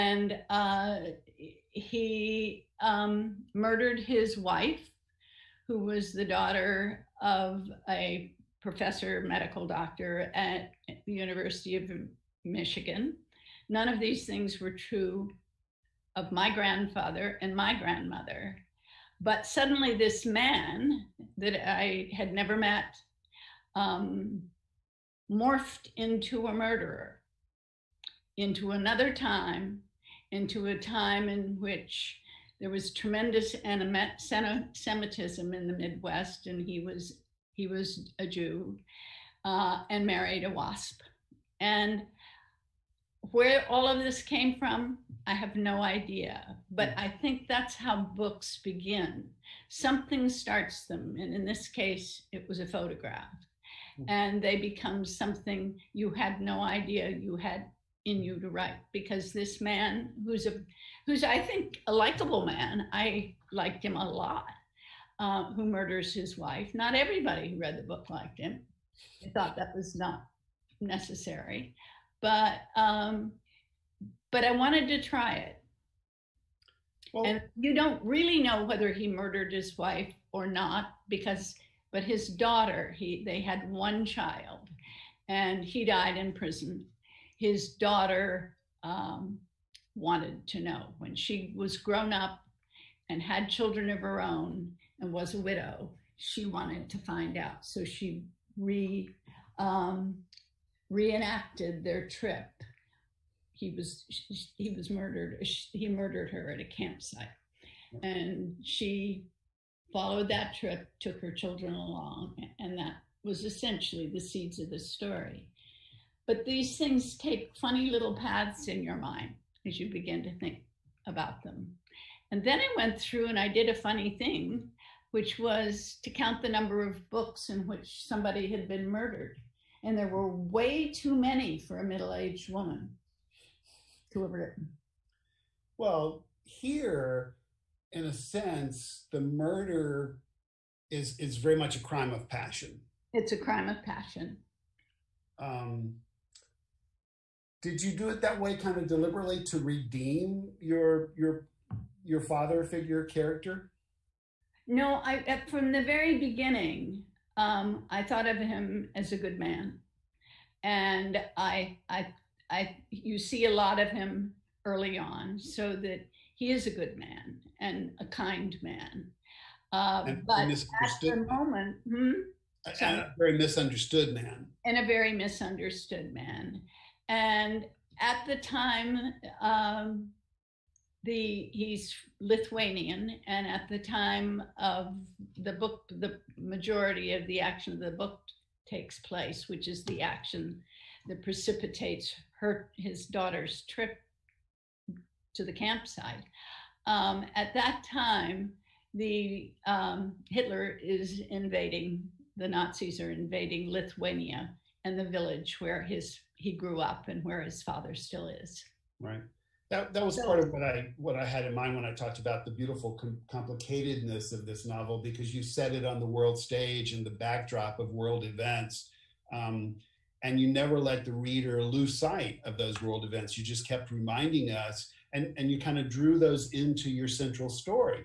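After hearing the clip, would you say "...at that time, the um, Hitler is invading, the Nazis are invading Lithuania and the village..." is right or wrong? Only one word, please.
right.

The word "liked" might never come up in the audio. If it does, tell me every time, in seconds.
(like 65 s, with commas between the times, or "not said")
63 s, 68 s.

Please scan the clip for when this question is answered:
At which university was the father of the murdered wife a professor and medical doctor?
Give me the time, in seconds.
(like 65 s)
11 s.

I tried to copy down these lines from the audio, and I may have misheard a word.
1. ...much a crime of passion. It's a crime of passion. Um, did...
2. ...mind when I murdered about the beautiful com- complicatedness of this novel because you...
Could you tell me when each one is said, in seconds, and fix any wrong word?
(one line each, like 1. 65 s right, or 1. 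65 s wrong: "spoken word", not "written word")
1. 141 s right
2. 211 s wrong: "talked", not "murdered".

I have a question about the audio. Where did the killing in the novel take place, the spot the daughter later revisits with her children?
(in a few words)
A campsite.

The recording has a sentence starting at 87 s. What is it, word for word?
His daughter um, wanted to know when she was grown up and had children of her own and was a widow.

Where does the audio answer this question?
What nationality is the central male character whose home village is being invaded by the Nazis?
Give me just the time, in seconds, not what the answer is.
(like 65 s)
182 s.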